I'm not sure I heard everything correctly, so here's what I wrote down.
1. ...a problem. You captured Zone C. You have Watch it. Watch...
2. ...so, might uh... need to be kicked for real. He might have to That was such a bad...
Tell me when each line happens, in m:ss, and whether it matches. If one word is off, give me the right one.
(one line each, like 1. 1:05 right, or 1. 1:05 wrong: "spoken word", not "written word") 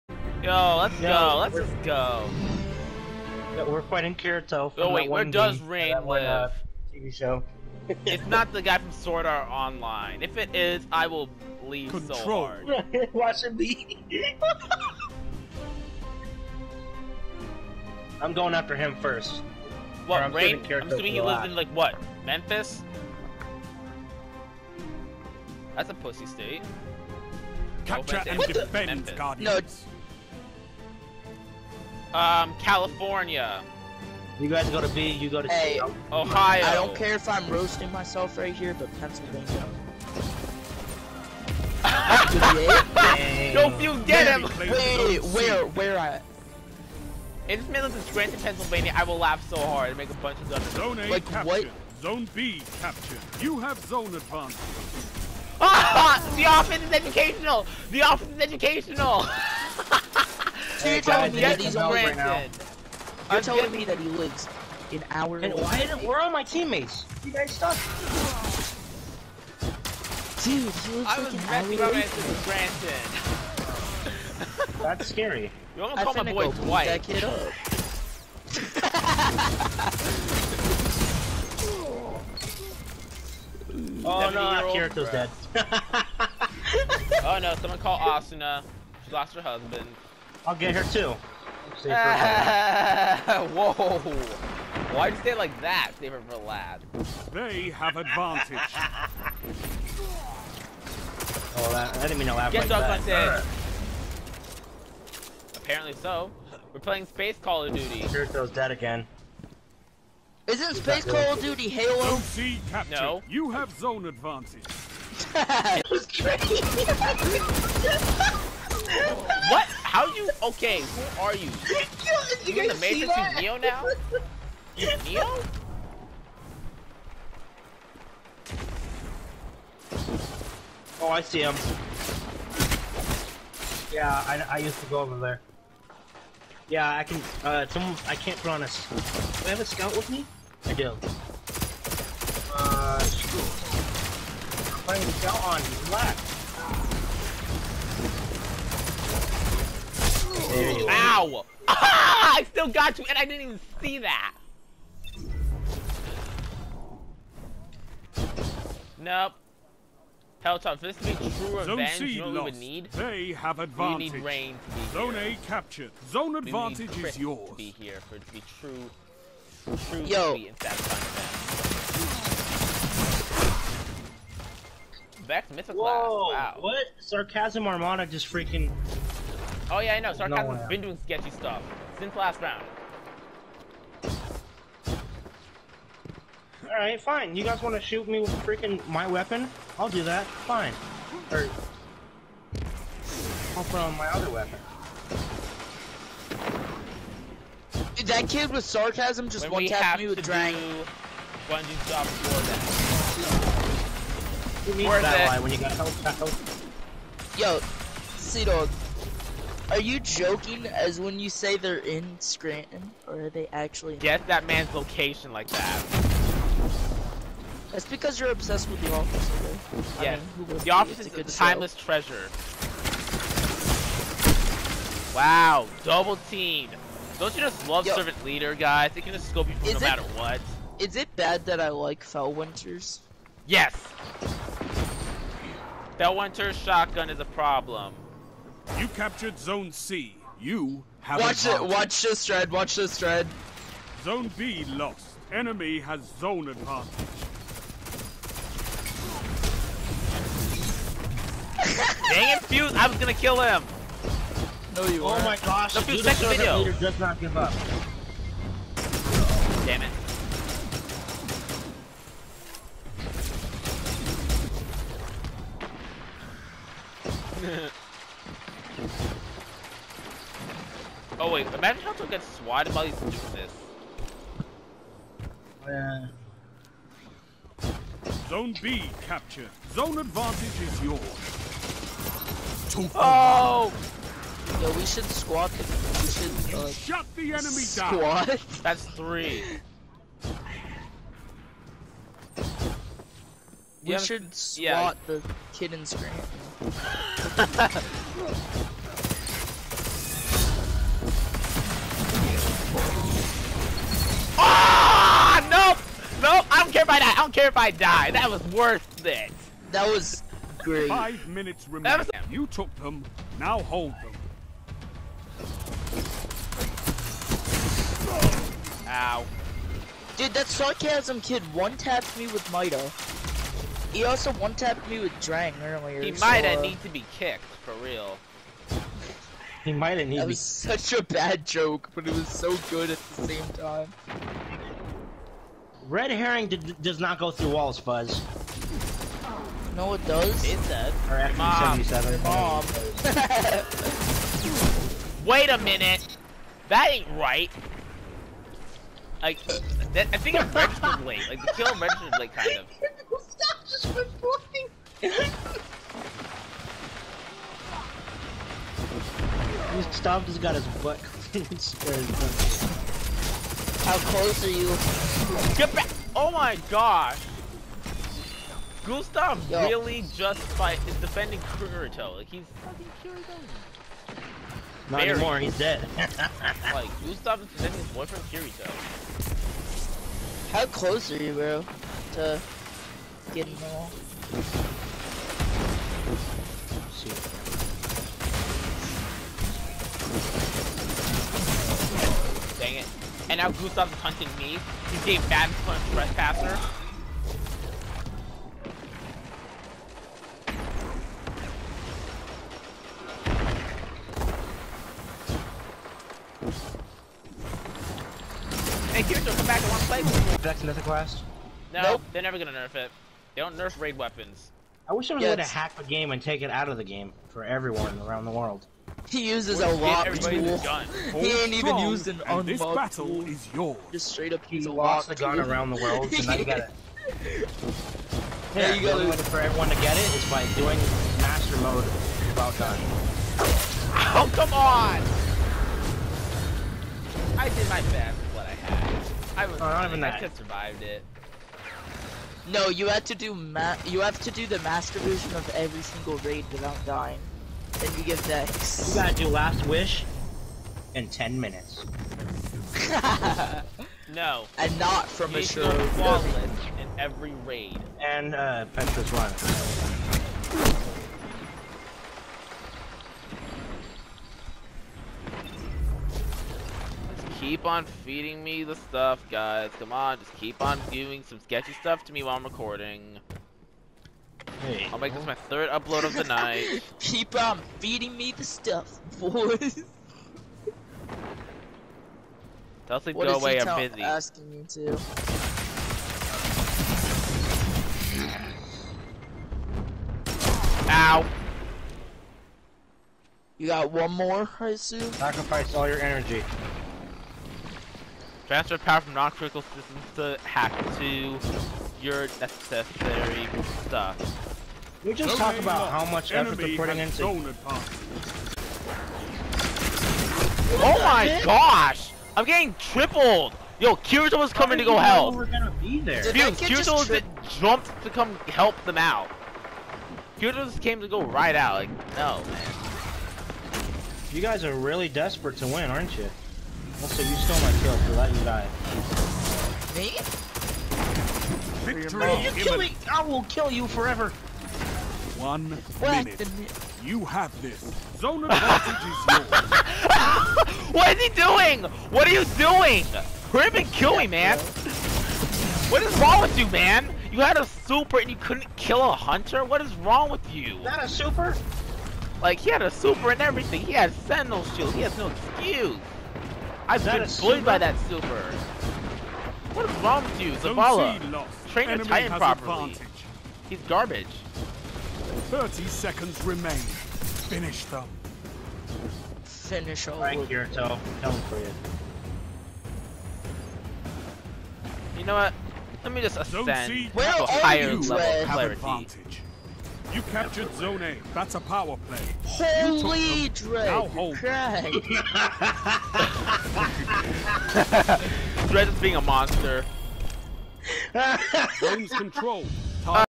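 1. 3:57 right
2. 5:26 right.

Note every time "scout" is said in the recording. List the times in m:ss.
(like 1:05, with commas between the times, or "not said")
2:19, 2:25.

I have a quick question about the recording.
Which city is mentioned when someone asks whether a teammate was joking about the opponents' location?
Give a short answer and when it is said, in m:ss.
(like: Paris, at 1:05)
Scranton, at 3:32.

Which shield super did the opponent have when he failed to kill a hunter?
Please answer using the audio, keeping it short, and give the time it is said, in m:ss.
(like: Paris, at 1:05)
Sentinel shield, at 9:14.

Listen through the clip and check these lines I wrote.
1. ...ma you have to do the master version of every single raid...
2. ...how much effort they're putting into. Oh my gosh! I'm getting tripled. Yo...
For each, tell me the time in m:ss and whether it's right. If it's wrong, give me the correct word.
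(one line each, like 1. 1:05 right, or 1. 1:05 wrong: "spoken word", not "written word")
1. 7:23 right
2. 8:25 right.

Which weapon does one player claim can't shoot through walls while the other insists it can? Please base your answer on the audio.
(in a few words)
Red Herring.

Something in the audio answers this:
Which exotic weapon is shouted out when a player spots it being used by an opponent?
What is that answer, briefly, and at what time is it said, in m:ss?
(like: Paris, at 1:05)
Vex Mythoclast, at 2:55.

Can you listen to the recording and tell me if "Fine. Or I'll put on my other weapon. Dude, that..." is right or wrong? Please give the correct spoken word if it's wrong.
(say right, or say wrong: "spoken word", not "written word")
right.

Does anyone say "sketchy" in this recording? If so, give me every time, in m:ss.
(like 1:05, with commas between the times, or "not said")
3:01, 7:51.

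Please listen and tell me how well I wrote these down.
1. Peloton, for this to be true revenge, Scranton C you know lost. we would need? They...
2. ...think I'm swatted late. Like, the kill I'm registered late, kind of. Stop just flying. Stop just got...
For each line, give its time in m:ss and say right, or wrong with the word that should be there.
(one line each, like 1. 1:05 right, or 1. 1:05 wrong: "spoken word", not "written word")
1. 2:40 wrong: "Zone", not "Scranton"
2. 5:50 wrong: "registered", not "swatted".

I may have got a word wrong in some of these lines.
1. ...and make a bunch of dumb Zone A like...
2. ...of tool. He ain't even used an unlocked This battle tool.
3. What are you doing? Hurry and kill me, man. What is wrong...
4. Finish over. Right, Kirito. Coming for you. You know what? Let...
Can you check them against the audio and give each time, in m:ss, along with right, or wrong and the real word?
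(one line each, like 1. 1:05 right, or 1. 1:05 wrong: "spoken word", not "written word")
1. 0:49 right
2. 7:00 right
3. 9:02 right
4. 9:29 right.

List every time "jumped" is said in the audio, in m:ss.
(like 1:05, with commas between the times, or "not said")
8:37.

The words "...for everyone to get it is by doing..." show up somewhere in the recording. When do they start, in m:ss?
7:09.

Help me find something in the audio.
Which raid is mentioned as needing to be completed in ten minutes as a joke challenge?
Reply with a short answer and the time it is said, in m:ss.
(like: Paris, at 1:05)
Last Wish, at 7:29.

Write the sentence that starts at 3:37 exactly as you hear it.
That's because you're obsessed with the office, okay?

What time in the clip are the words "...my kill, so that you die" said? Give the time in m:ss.
8:47.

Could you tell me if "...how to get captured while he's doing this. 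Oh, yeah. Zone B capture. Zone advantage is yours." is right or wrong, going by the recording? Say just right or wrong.
wrong.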